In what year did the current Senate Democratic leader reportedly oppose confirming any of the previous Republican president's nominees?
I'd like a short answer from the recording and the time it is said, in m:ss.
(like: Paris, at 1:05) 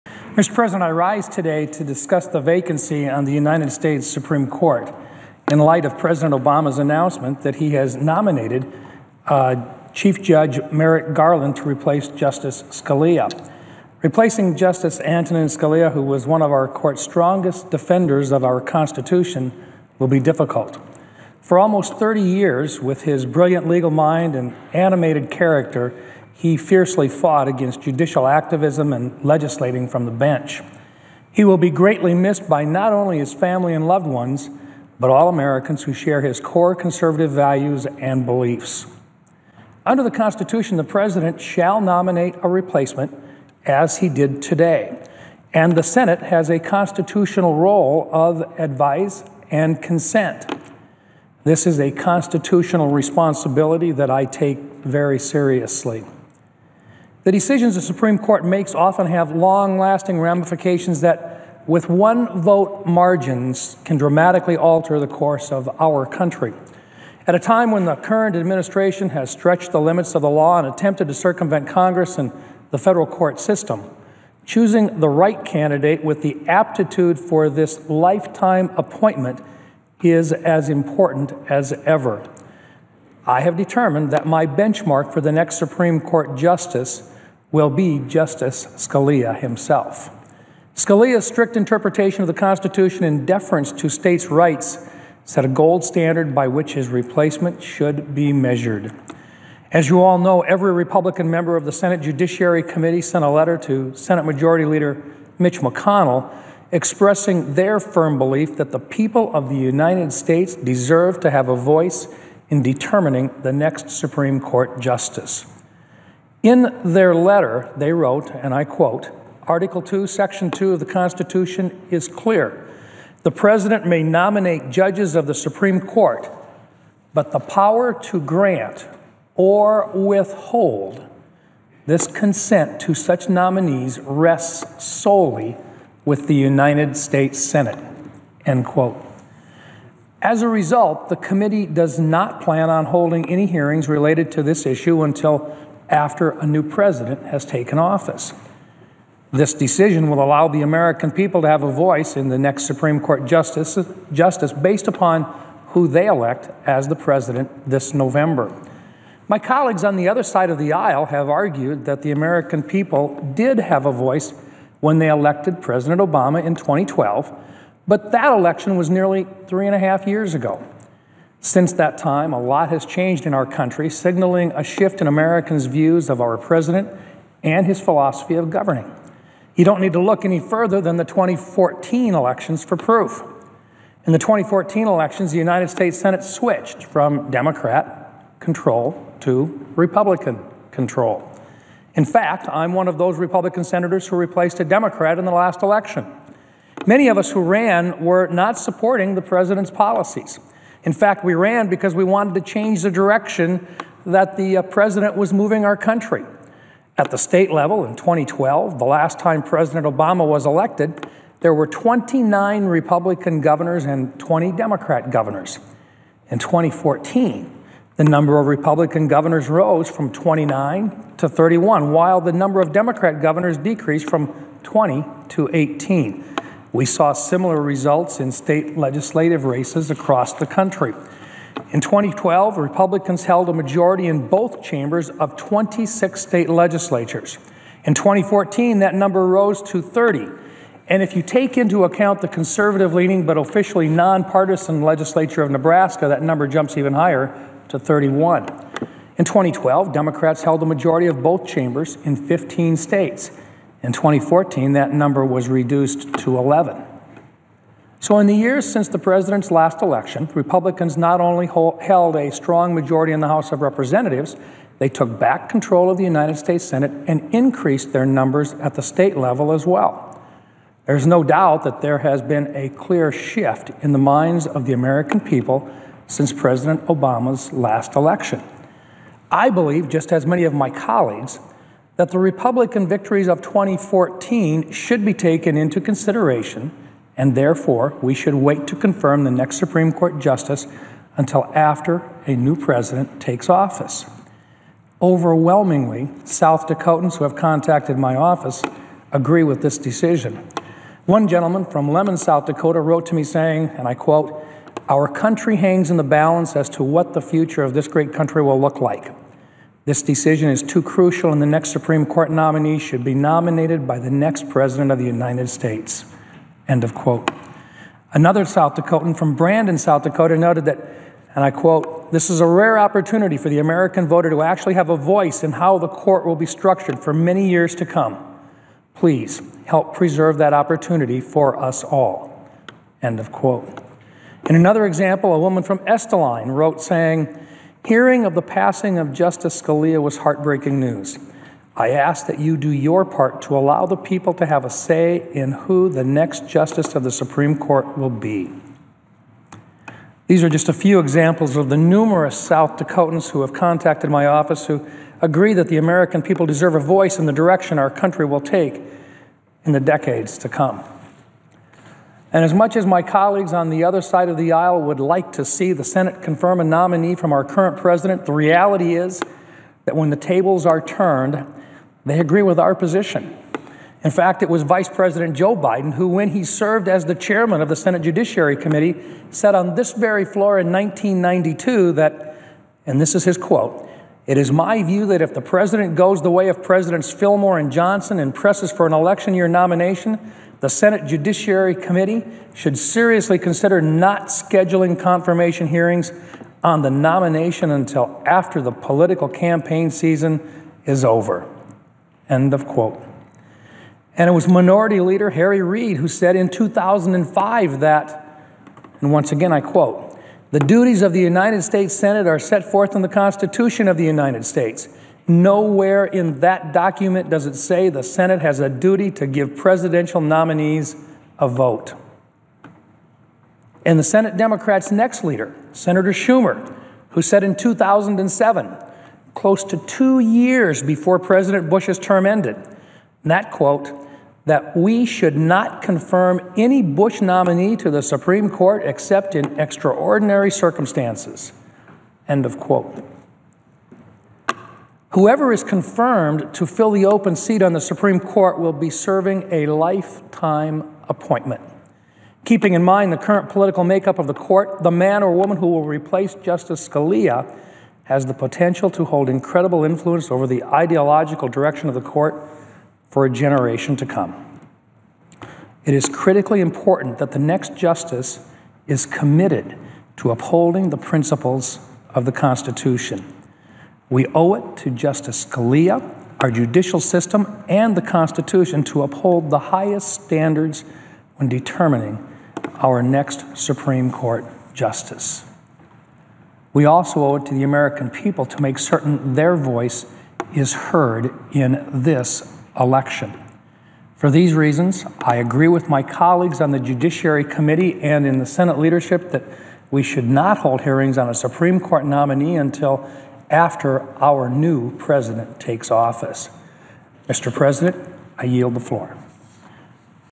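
2005, at 6:46.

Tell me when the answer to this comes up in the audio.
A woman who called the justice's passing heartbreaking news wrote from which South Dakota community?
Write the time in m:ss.
5:35.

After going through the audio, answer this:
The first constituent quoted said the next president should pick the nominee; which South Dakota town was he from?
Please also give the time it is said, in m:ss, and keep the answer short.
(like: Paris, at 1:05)
Lemmon, at 5:01.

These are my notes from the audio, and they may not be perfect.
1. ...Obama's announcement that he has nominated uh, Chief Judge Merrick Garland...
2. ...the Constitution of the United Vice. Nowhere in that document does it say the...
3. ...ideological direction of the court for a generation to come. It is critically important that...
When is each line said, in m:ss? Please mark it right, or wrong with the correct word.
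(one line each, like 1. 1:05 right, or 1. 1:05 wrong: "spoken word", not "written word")
1. 0:06 right
2. 6:53 wrong: "States", not "Vice"
3. 7:40 right.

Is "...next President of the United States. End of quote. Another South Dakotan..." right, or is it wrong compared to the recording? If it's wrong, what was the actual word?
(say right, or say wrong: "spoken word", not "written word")
right.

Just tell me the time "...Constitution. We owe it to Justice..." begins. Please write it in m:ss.
7:52.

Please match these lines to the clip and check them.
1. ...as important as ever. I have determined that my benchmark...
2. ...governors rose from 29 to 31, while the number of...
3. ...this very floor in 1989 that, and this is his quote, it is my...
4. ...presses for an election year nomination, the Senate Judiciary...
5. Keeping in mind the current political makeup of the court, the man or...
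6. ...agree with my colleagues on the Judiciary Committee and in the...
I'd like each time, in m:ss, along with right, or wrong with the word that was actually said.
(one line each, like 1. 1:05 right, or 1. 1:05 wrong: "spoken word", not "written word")
1. 1:20 right
2. 3:39 right
3. 6:19 wrong: "1992", not "1989"
4. 6:28 right
5. 7:32 right
6. 8:15 right.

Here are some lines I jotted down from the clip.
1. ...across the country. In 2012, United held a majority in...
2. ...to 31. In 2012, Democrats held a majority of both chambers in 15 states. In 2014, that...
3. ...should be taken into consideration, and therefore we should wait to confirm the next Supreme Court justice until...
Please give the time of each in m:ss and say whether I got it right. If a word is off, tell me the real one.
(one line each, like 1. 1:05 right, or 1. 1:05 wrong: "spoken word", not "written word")
1. 3:49 wrong: "Republicans", not "United"
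2. 4:07 right
3. 4:44 right.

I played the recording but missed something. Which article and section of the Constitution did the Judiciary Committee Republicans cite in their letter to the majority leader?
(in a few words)
Article 2, Section 2.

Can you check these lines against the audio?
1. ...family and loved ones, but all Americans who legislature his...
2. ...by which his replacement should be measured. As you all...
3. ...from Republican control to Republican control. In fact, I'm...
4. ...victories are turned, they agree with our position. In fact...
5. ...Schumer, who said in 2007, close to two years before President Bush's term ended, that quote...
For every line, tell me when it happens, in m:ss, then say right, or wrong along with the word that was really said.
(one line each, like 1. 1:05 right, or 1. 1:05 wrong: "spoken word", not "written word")
1. 0:33 wrong: "share", not "legislature"
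2. 1:36 right
3. 3:06 wrong: "Democrat", not "Republican"
4. 6:10 wrong: "tables", not "victories"
5. 7:06 right.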